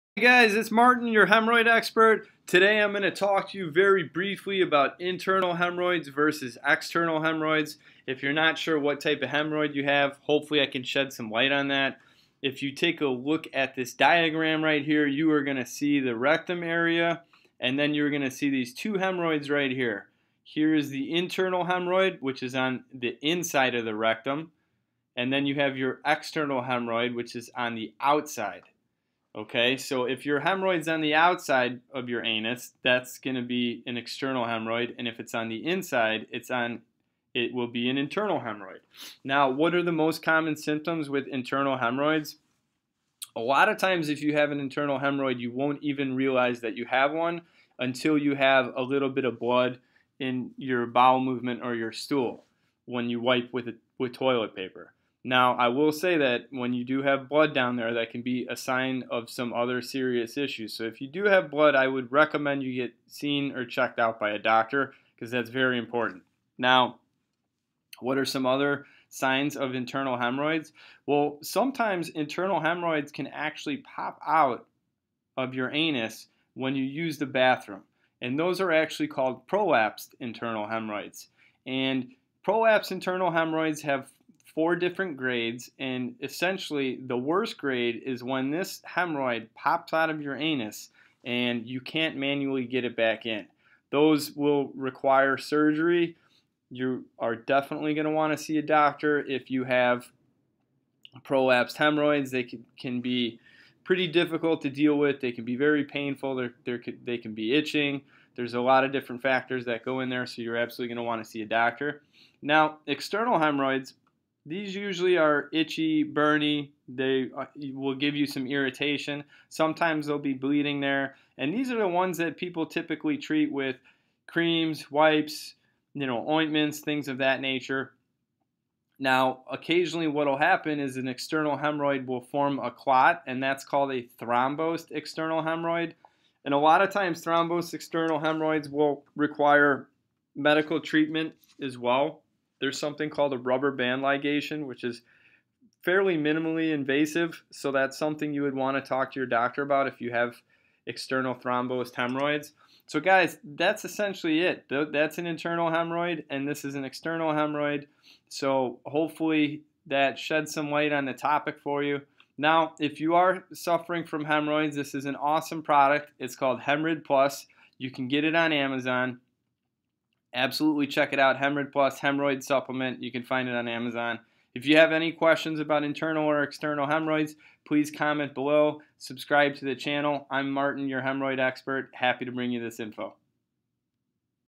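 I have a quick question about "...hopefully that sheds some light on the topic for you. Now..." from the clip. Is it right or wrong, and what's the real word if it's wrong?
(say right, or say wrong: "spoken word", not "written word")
right.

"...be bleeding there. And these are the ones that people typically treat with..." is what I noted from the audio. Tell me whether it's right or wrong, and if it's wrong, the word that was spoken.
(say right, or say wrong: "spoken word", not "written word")
right.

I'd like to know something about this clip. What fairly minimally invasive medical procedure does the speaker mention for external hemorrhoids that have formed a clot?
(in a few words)
Rubber band ligation.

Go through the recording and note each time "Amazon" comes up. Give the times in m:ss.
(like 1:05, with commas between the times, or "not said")
2:48, 2:53.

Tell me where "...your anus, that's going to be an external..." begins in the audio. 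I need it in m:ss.
0:32.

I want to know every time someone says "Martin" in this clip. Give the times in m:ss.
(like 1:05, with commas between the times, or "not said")
0:00, 3:00.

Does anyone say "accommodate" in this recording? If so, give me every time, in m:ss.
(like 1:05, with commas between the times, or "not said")
not said.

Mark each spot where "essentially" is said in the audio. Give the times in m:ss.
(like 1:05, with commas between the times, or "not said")
1:26, 2:33.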